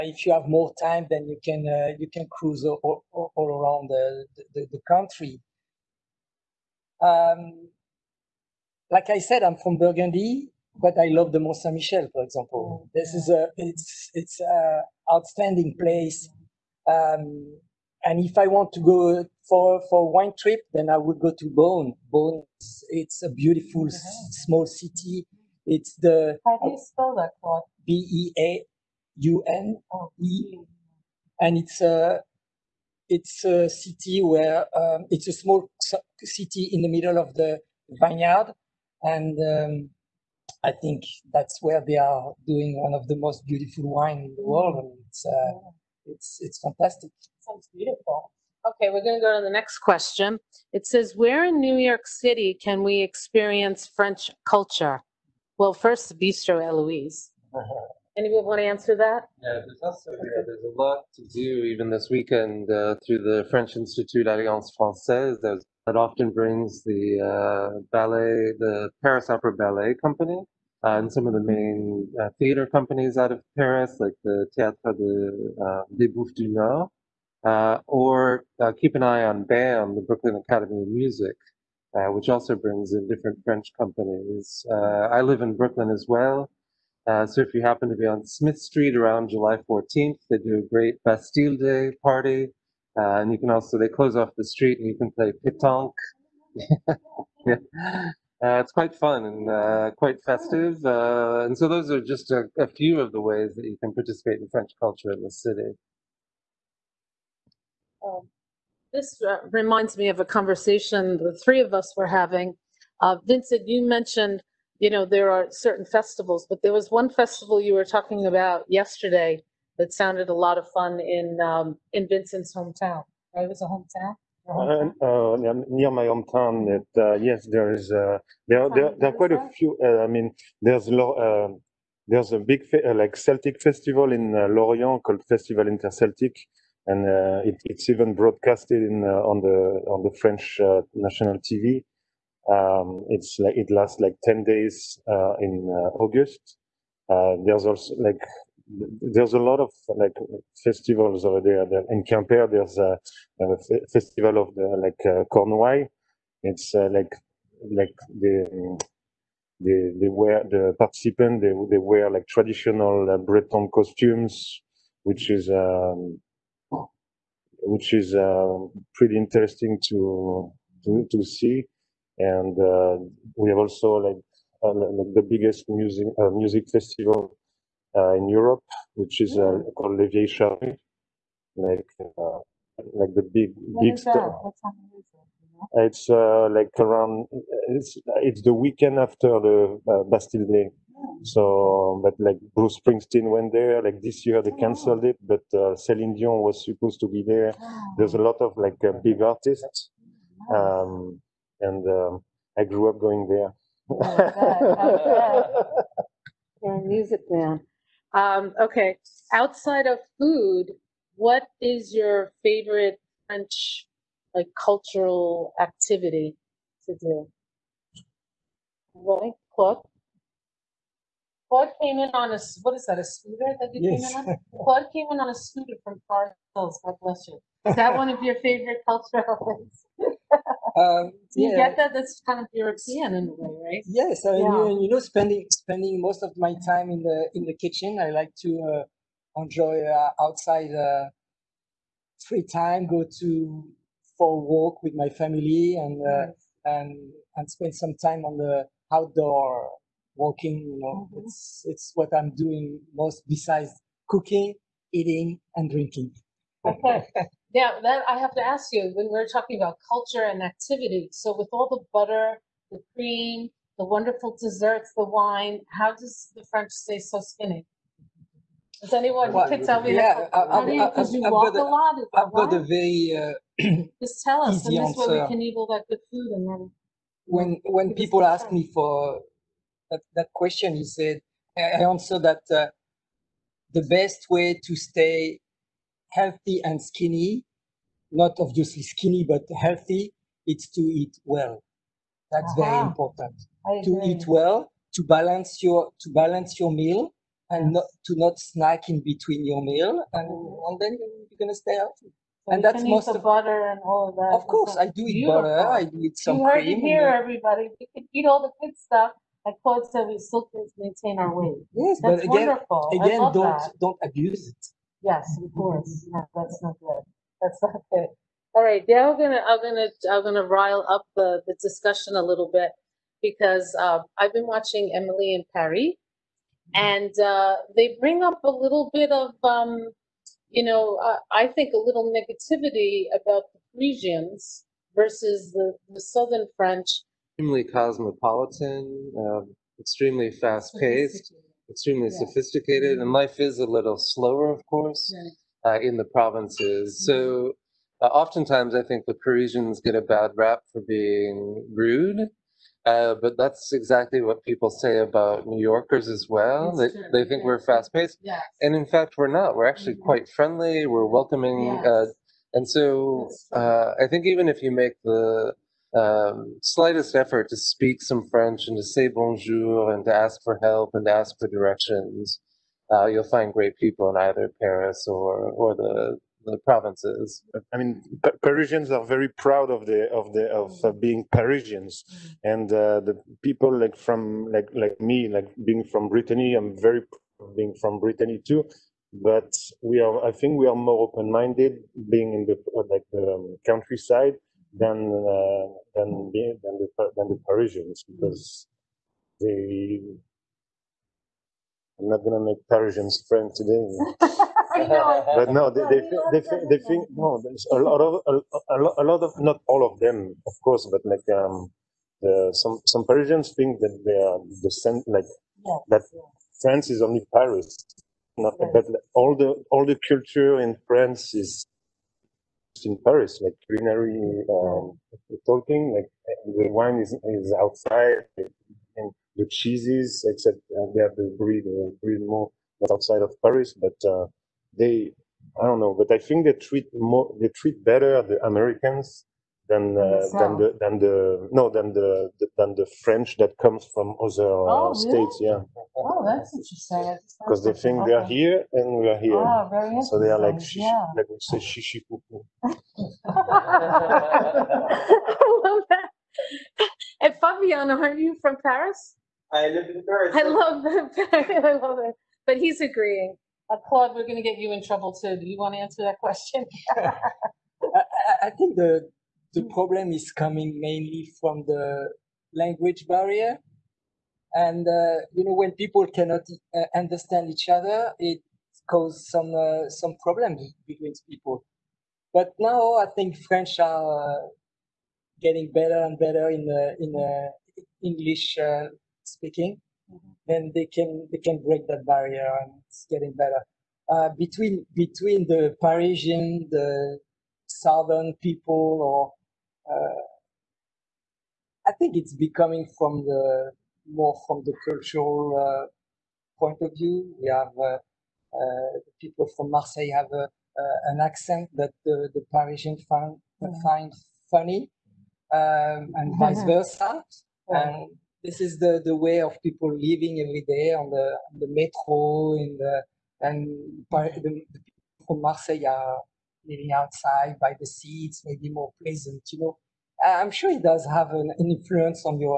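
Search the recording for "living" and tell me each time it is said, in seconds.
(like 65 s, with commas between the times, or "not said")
519 s, 526 s.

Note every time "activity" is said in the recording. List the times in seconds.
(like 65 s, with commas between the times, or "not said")
215 s, 260 s.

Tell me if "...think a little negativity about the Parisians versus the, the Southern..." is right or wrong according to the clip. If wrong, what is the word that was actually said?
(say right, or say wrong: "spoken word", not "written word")
right.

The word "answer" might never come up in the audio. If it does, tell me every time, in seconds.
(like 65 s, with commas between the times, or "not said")
58 s, 274 s, 281 s, 465 s.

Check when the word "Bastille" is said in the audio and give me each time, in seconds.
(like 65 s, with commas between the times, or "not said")
91 s, 190 s.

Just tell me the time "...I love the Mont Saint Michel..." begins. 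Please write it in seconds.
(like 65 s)
10 s.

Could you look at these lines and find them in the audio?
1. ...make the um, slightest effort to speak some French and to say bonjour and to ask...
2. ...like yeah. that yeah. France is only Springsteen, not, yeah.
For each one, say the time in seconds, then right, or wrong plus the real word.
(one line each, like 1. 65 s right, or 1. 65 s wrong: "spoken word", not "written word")
1. 364 s right
2. 415 s wrong: "Paris", not "Springsteen".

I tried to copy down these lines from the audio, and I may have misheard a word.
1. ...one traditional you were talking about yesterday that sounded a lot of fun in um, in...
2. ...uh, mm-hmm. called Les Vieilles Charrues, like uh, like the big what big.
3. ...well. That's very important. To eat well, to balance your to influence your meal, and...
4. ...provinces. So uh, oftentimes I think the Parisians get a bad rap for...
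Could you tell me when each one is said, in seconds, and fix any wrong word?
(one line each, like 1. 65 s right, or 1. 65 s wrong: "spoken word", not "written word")
1. 116 s wrong: "festival", not "traditional"
2. 179 s right
3. 291 s wrong: "balance", not "influence"
4. 346 s right.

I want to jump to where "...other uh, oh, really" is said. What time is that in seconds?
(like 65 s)
444 s.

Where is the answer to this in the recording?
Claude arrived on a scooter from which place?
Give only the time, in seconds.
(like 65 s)
226 s.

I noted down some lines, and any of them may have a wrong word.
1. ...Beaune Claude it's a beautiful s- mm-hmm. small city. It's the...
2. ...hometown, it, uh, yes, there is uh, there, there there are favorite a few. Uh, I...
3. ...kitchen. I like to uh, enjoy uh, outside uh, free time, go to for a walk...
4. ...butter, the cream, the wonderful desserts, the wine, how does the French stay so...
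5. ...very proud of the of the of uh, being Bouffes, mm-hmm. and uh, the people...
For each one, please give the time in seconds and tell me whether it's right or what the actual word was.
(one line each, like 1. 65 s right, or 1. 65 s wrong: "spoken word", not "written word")
1. 21 s wrong: "Beaune", not "Claude"
2. 126 s wrong: "quite", not "favorite"
3. 237 s right
4. 261 s right
5. 379 s wrong: "Parisians", not "Bouffes".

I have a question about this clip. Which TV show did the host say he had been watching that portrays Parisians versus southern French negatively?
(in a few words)
Emily in Paris.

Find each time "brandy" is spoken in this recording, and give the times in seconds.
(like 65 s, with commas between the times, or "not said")
not said.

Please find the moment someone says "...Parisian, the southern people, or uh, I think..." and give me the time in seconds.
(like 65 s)
495 s.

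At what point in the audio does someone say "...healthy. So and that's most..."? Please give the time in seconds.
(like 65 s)
301 s.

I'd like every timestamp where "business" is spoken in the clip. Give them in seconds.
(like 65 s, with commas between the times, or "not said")
not said.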